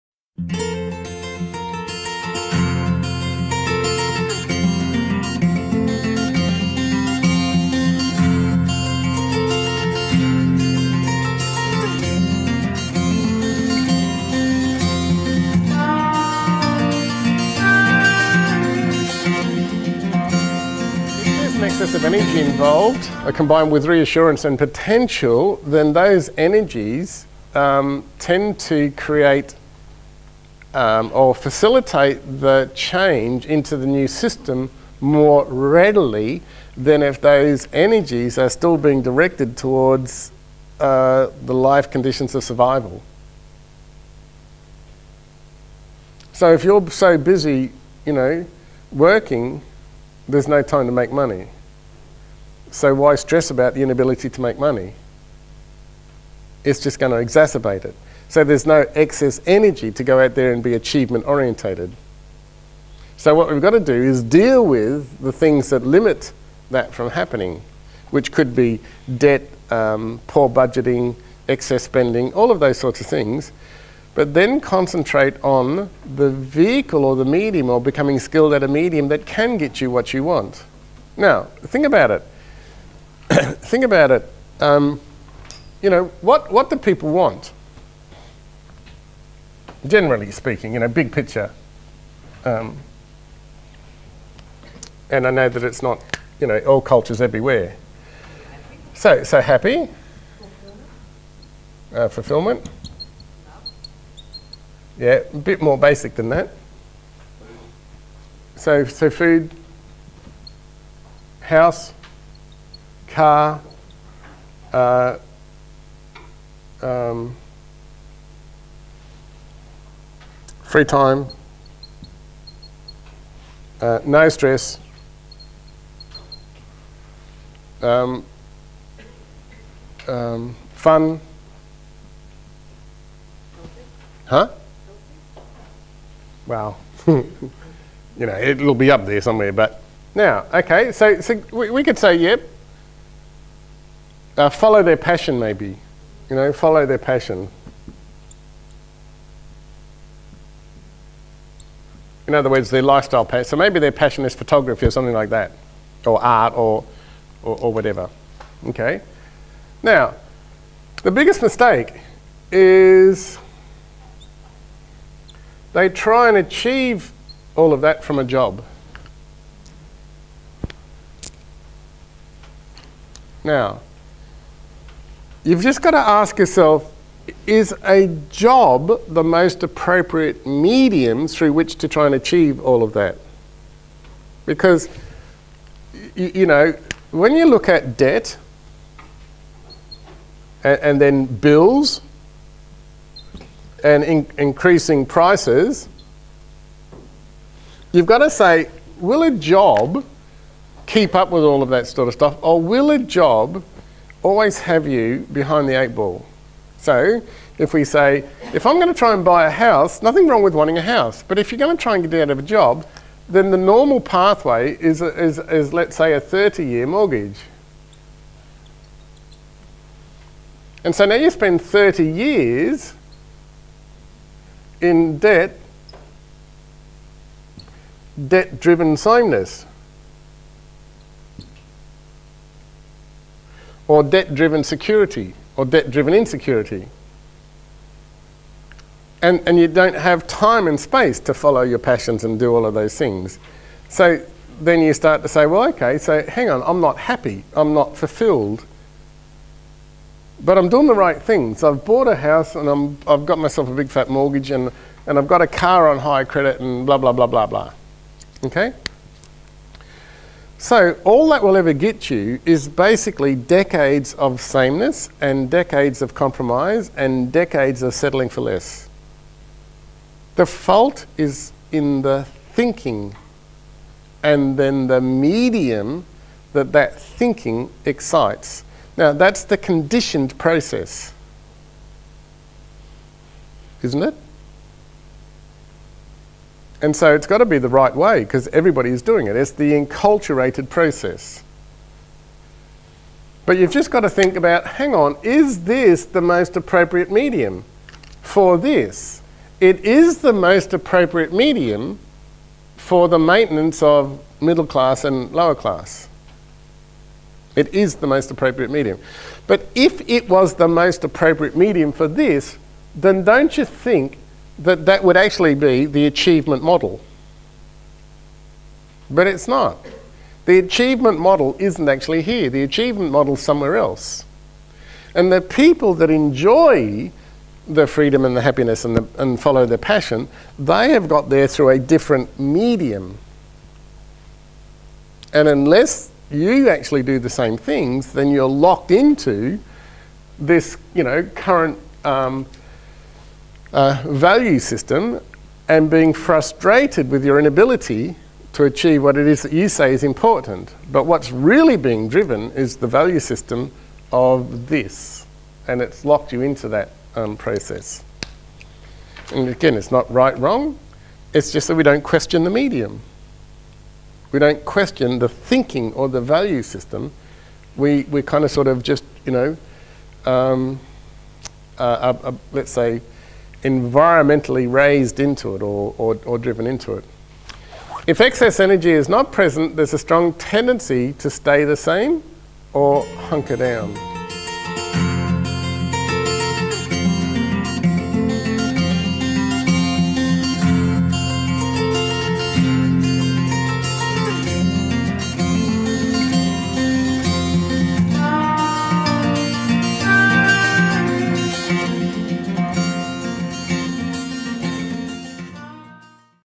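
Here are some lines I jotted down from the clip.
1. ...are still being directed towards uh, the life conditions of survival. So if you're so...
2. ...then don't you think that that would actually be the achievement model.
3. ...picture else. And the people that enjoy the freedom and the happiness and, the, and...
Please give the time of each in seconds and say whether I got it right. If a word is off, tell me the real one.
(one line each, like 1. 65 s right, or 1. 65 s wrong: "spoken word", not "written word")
1. 38 s right
2. 312 s right
3. 323 s wrong: "somewhere", not "picture".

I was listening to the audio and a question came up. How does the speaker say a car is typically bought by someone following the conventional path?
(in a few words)
on high credit.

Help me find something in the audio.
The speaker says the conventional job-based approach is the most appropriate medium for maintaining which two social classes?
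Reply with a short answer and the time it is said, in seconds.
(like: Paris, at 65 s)
middle class and lower class, at 304 s.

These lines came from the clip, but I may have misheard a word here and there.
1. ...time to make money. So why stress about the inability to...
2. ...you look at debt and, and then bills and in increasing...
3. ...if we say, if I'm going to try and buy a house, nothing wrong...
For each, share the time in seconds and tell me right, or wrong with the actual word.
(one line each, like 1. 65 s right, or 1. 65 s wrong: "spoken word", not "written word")
1. 50 s right
2. 187 s right
3. 207 s right.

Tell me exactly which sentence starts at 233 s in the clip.
Or debt driven security or debt-driven insecurity.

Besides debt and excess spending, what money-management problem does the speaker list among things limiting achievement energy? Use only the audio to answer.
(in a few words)
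poor budgeting.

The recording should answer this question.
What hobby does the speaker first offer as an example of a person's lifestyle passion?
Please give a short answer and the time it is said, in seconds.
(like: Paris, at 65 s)
photography, at 154 s.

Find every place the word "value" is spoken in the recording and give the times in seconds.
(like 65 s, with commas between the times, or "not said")
344 s, 352 s, 366 s.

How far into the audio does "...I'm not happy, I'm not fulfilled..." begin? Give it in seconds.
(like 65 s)
246 s.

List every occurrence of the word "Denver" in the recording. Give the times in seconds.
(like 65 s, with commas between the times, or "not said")
not said.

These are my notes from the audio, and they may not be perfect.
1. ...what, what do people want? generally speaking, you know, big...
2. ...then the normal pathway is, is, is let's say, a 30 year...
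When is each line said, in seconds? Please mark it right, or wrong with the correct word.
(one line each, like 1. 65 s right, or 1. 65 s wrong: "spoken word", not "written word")
1. 86 s right
2. 213 s right.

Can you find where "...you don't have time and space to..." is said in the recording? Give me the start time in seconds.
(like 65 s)
239 s.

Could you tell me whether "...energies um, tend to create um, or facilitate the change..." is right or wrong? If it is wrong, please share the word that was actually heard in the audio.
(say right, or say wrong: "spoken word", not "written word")
right.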